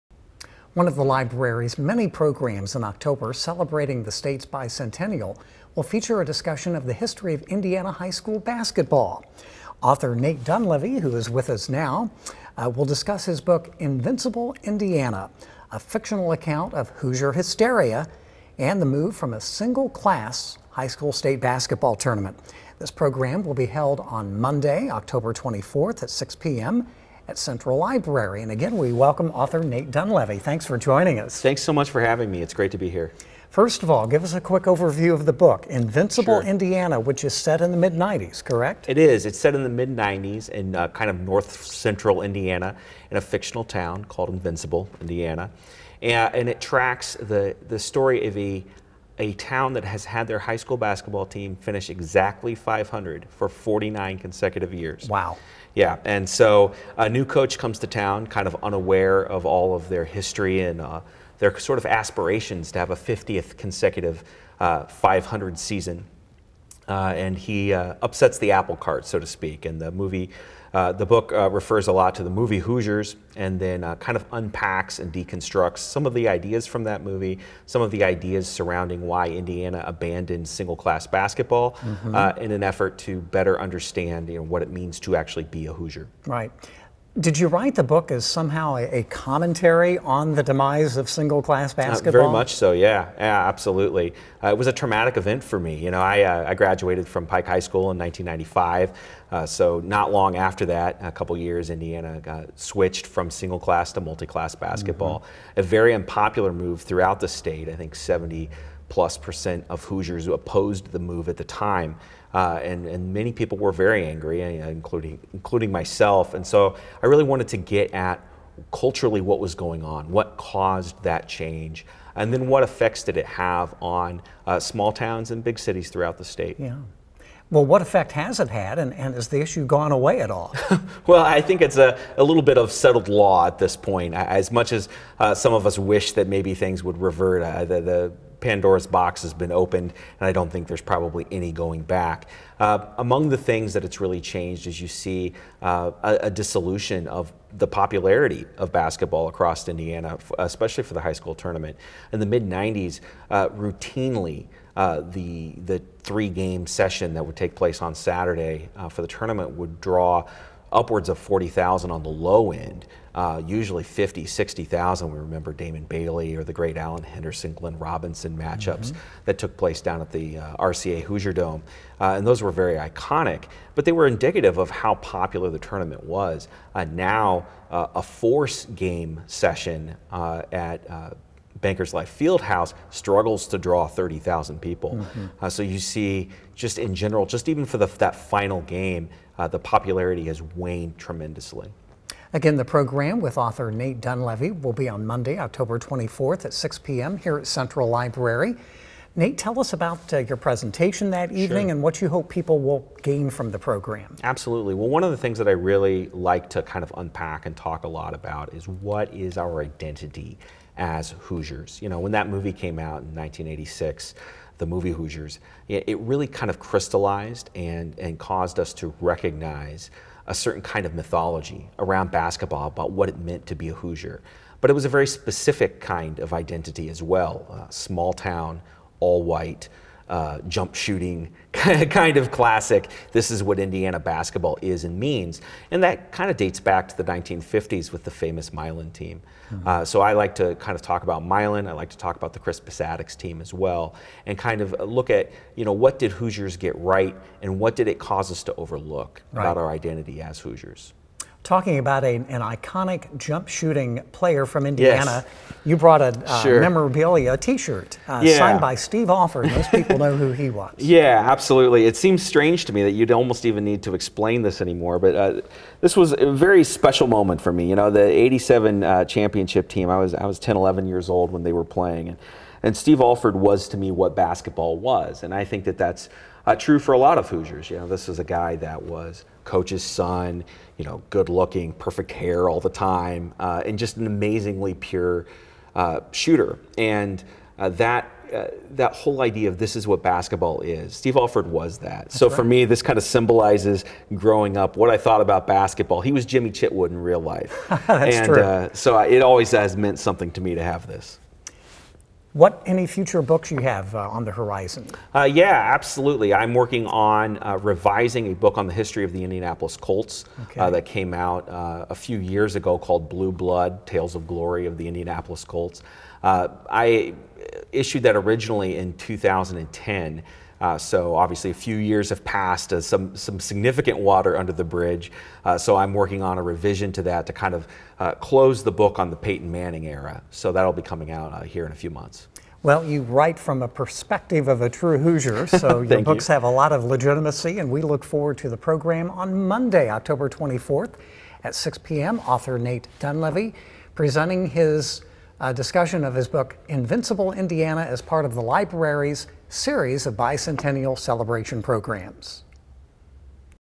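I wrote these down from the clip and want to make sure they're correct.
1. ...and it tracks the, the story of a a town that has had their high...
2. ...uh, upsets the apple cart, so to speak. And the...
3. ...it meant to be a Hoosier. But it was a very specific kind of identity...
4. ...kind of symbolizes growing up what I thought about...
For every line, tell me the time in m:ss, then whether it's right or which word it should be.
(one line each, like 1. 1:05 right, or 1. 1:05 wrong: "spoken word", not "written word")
1. 0:46 right
2. 1:07 right
3. 3:43 right
4. 4:52 right.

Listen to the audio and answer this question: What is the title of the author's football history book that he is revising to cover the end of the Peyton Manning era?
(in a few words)
Blue Blood.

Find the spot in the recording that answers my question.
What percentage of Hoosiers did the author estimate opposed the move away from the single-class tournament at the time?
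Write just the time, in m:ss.
1:47.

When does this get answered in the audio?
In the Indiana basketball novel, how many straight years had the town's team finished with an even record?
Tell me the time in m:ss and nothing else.
0:53.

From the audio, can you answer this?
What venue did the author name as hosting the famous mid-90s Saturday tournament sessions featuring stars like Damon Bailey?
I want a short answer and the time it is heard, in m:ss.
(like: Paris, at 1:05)
RCA Hoosier Dome, at 2:50.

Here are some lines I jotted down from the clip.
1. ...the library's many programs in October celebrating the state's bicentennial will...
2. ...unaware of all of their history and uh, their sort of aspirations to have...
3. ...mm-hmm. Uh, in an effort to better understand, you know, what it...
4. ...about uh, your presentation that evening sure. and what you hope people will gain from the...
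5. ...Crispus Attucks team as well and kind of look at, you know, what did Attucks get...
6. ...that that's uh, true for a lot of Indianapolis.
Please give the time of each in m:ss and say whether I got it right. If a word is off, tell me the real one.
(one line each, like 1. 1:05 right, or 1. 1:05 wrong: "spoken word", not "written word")
1. 0:00 right
2. 0:58 right
3. 1:21 right
4. 3:19 right
5. 4:02 wrong: "Hoosiers", not "Attucks"
6. 4:35 wrong: "Hoosiers", not "Indianapolis".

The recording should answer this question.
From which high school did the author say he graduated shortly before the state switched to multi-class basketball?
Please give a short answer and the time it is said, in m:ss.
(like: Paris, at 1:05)
Pike High School, at 1:37.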